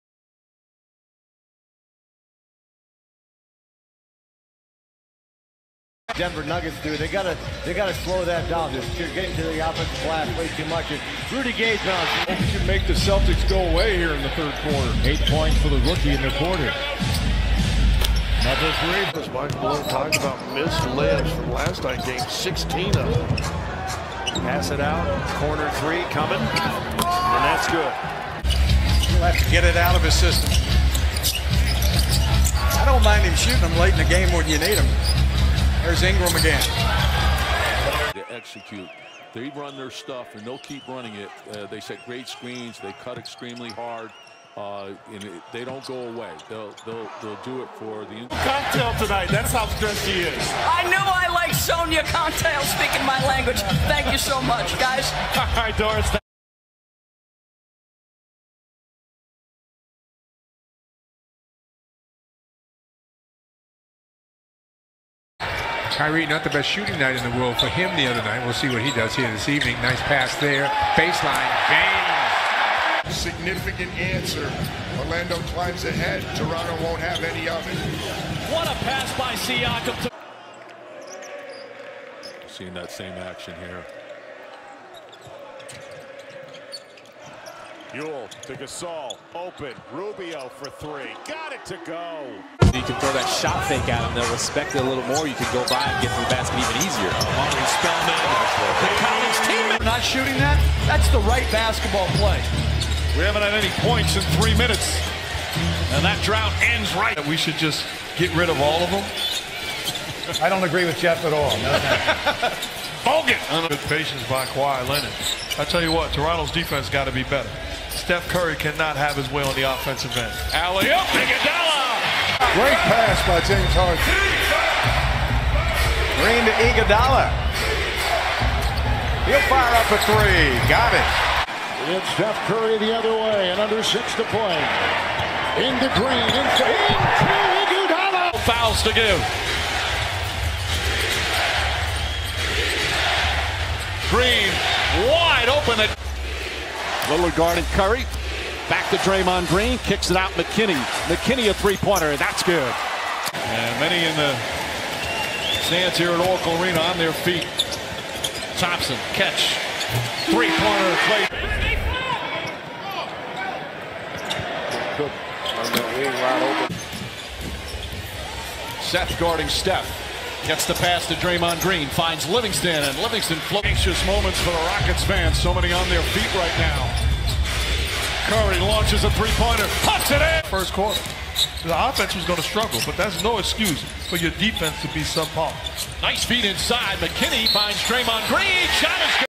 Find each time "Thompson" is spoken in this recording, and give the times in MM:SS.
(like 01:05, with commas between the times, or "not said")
02:38.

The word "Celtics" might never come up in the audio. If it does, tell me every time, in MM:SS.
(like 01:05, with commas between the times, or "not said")
00:12.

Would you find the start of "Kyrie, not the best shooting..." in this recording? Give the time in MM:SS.
01:06.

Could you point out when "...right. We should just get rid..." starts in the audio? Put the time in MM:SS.
01:46.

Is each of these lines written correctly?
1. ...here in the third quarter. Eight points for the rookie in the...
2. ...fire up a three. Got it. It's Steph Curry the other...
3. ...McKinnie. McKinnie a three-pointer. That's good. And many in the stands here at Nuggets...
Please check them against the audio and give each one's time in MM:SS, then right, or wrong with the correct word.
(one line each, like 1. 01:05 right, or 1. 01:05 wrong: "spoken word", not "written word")
1. 00:13 right
2. 02:09 right
3. 02:30 wrong: "Oracle", not "Nuggets".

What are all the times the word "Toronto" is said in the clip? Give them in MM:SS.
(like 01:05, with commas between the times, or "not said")
01:16, 01:56.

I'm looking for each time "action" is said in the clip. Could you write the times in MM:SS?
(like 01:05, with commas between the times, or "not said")
01:23.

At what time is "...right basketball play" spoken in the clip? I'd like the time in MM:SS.
01:41.